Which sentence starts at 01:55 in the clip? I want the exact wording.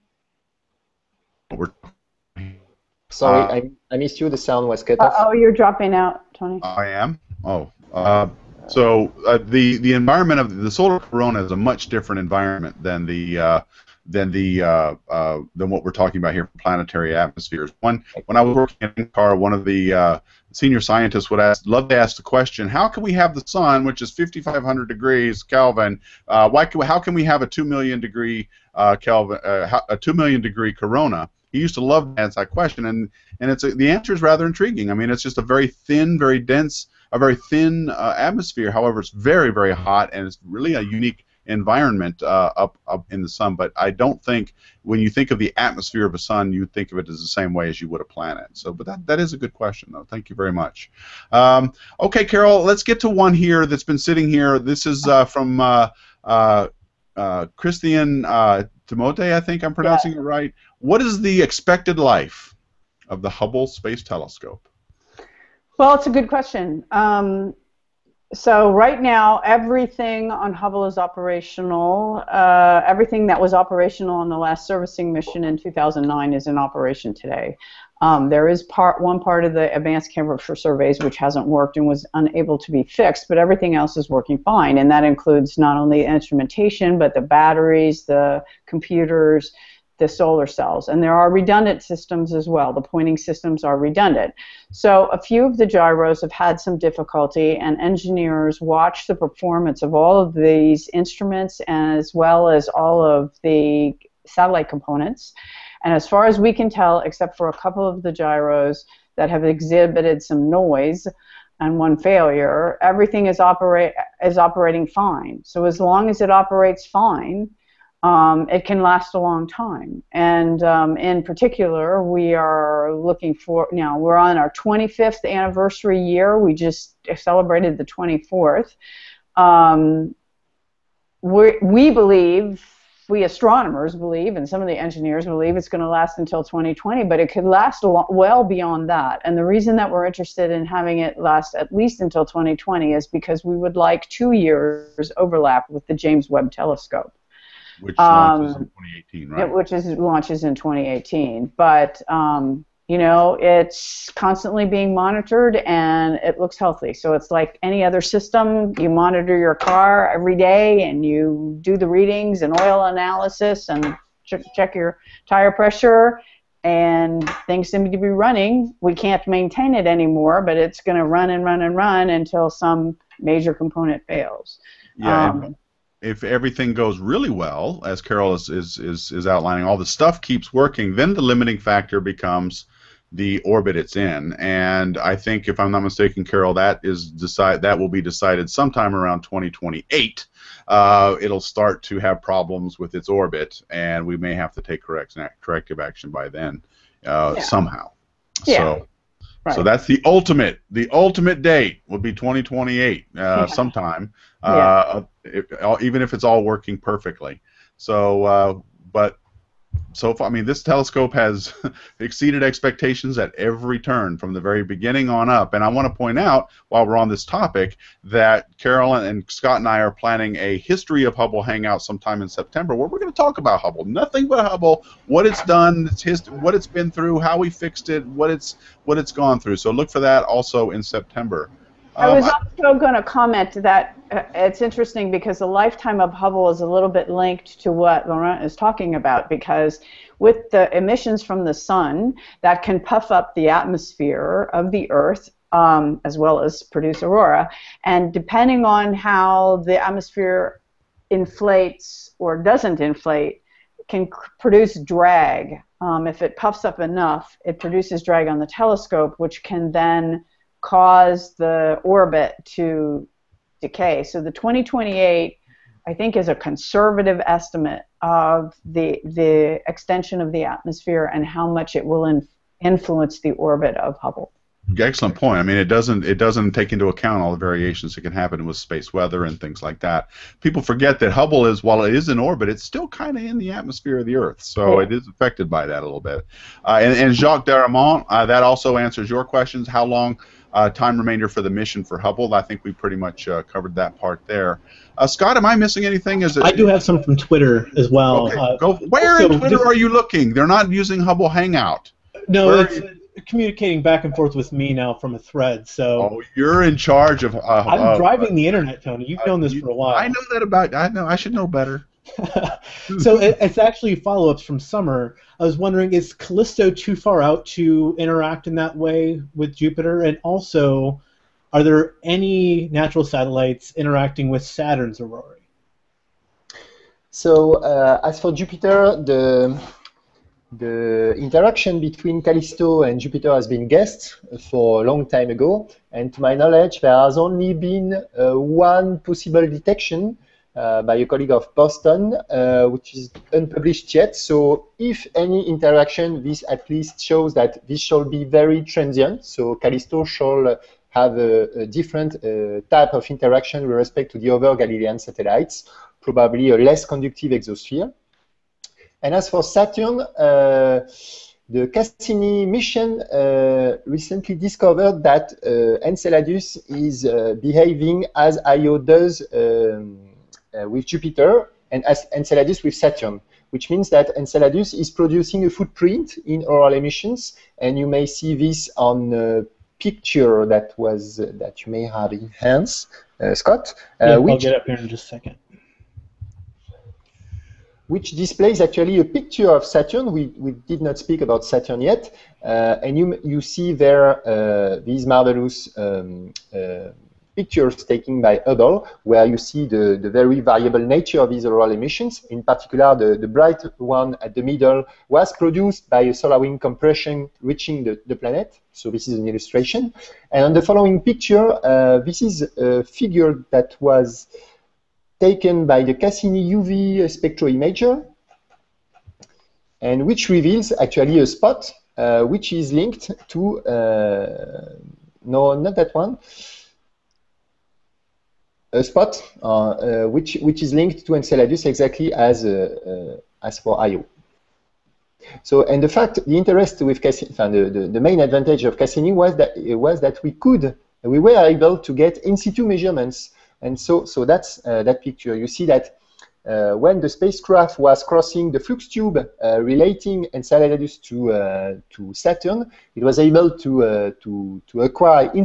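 So as long as it operates fine, um, it can last a long time.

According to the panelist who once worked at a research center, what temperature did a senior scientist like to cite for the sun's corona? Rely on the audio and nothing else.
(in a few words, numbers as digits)
2 million degrees Kelvin.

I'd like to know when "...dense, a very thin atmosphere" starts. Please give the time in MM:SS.
00:36.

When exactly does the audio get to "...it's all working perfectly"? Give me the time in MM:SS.
03:26.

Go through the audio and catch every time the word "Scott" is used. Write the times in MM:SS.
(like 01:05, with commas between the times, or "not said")
03:39, 04:55, 06:23.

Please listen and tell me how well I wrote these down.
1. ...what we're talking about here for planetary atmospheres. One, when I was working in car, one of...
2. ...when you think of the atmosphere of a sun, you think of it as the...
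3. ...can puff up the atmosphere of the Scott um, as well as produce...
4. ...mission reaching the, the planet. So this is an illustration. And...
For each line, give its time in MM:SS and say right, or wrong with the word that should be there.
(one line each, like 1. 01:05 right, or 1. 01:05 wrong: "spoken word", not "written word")
1. 00:15 right
2. 00:44 right
3. 04:02 wrong: "Earth", not "Scott"
4. 06:46 wrong: "compression", not "mission".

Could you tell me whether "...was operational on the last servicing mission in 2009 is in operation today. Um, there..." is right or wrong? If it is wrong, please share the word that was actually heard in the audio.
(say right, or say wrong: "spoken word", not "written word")
right.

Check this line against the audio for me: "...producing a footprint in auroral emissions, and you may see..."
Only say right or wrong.
right.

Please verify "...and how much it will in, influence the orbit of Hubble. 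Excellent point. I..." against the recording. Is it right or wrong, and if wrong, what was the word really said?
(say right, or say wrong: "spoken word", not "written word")
right.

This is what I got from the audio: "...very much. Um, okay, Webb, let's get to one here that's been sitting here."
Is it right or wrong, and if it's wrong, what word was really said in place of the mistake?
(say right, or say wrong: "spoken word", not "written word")
wrong: "Carol", not "Webb".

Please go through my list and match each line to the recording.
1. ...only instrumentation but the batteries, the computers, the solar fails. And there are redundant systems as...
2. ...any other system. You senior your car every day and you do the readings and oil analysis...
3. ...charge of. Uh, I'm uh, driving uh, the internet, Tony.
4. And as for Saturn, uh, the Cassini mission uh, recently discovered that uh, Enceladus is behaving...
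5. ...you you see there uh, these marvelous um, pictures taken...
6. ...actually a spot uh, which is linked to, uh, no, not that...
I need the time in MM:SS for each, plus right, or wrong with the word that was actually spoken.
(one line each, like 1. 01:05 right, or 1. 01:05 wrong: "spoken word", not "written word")
1. 01:25 wrong: "cells", not "fails"
2. 02:37 wrong: "monitor", not "senior"
3. 05:06 right
4. 05:59 right
5. 06:32 right
6. 07:00 right.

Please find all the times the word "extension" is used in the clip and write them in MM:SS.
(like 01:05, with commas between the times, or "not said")
04:29.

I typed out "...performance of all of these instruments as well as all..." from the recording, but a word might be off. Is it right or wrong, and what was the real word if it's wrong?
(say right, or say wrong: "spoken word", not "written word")
right.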